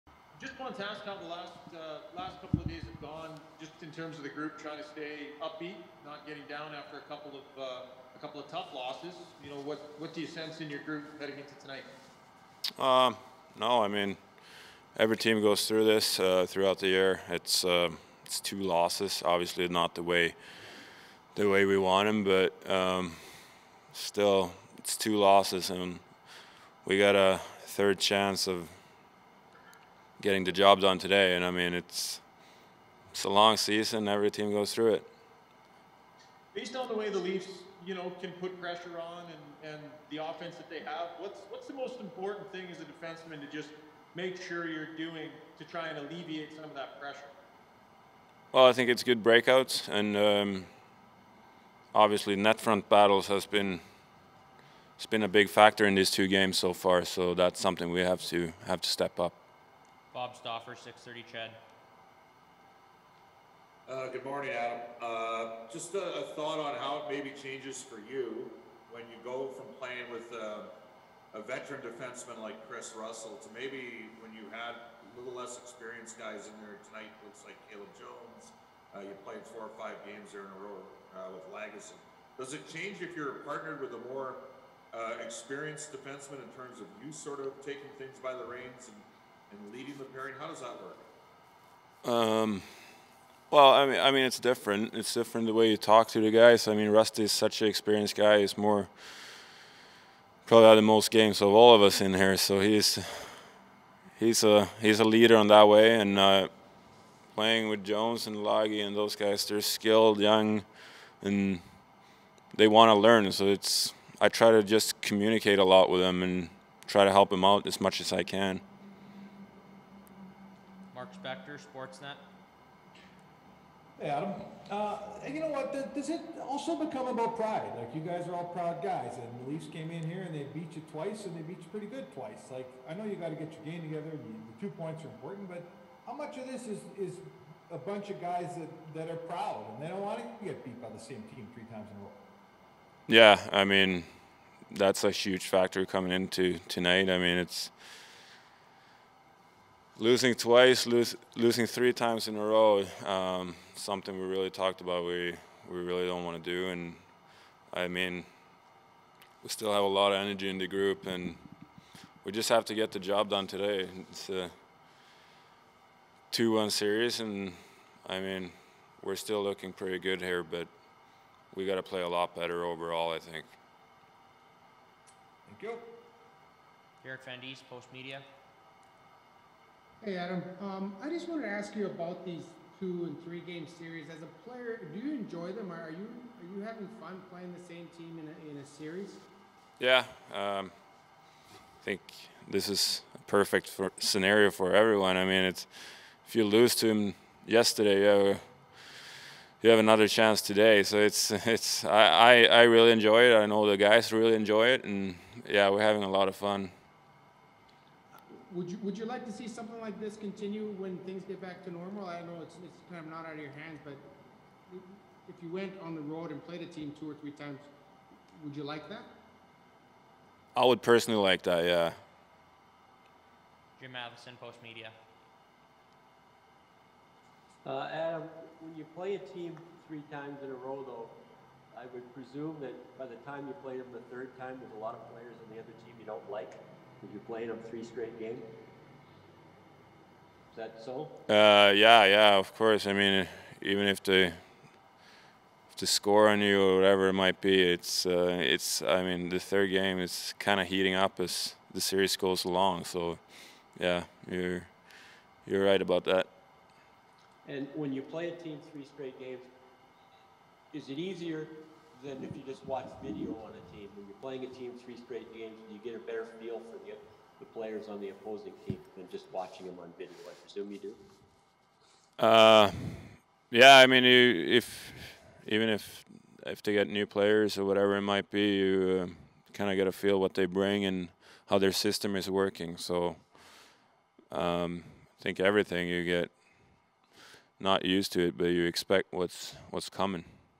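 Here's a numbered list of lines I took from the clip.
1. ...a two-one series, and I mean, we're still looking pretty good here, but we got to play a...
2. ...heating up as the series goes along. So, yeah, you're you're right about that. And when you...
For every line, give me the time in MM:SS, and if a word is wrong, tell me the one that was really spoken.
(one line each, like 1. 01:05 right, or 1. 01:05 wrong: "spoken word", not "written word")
1. 02:44 right
2. 04:10 right.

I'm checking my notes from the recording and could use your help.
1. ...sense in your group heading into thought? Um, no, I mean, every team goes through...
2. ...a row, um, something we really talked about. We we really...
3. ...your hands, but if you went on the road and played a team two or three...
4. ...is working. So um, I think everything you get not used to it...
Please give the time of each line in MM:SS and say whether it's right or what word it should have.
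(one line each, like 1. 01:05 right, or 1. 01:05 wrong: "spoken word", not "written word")
1. 00:10 wrong: "tonight", not "thought"
2. 02:32 right
3. 03:33 right
4. 04:42 right.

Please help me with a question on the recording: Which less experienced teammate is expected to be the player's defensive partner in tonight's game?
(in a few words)
Caleb Jones.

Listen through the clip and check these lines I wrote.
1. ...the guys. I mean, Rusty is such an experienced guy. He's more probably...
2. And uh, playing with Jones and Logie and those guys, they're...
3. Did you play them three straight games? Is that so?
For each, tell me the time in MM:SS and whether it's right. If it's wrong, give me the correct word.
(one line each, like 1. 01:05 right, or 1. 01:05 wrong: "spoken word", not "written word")
1. 01:36 right
2. 01:45 right
3. 03:57 right.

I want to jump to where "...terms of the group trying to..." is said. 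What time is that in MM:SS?
00:03.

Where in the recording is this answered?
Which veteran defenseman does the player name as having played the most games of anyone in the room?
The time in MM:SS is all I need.
01:12.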